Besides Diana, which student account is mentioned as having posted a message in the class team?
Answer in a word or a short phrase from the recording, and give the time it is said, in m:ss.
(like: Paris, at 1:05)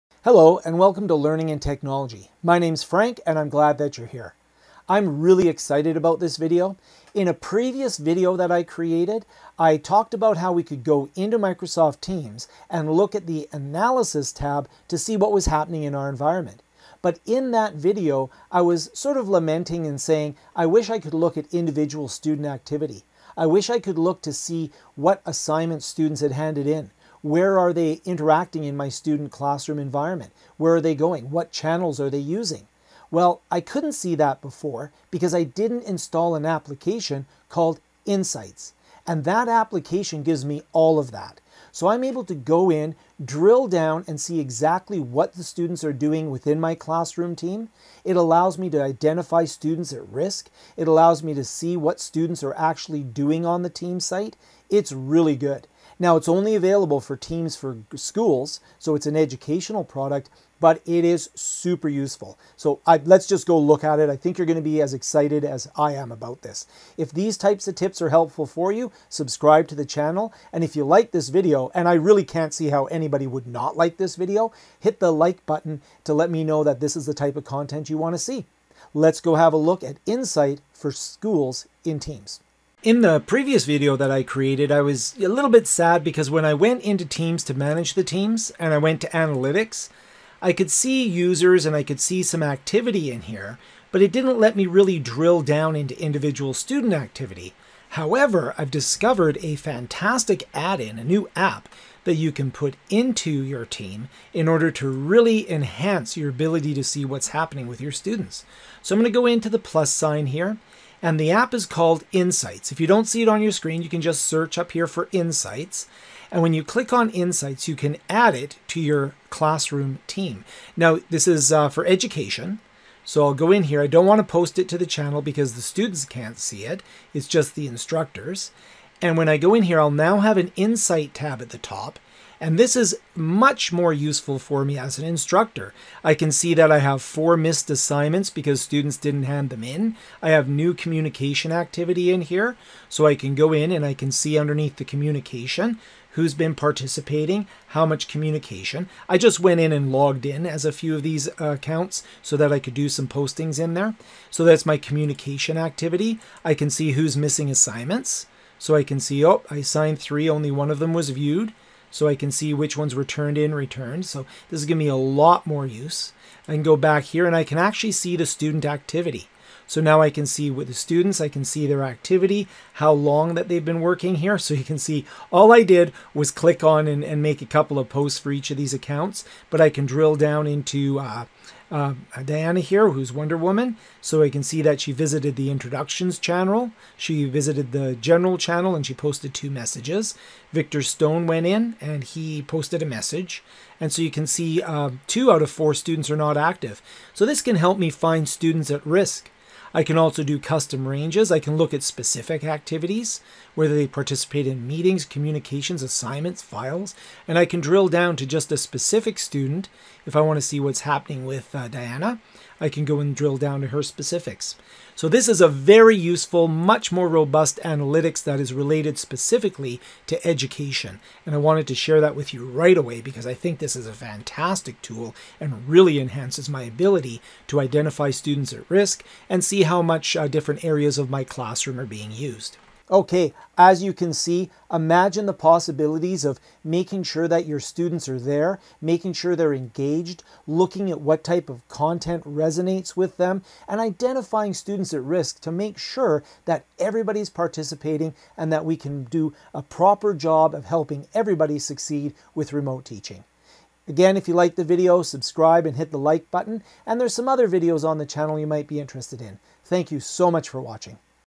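Victor Stone, at 3:10.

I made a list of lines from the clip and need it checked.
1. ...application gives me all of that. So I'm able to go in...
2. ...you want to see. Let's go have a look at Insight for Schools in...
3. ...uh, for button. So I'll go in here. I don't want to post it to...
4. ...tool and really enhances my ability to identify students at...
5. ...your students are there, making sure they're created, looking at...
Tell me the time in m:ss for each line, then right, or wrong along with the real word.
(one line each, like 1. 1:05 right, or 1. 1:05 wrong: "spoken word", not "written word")
1. 0:39 right
2. 1:17 right
3. 2:01 wrong: "education", not "button"
4. 3:44 right
5. 3:57 wrong: "engaged", not "created".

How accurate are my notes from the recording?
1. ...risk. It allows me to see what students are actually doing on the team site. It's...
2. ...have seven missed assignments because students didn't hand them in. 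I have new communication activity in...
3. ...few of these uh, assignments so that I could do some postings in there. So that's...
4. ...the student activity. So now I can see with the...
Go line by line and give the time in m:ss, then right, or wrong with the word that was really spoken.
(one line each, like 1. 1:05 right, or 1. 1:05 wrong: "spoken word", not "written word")
1. 0:50 right
2. 2:16 wrong: "four", not "seven"
3. 2:30 wrong: "accounts", not "assignments"
4. 2:48 right.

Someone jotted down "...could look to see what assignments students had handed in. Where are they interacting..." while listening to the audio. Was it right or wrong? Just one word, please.
right.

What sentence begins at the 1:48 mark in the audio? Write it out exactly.
So I'm going to go into the plus sign here and the app is called Insights.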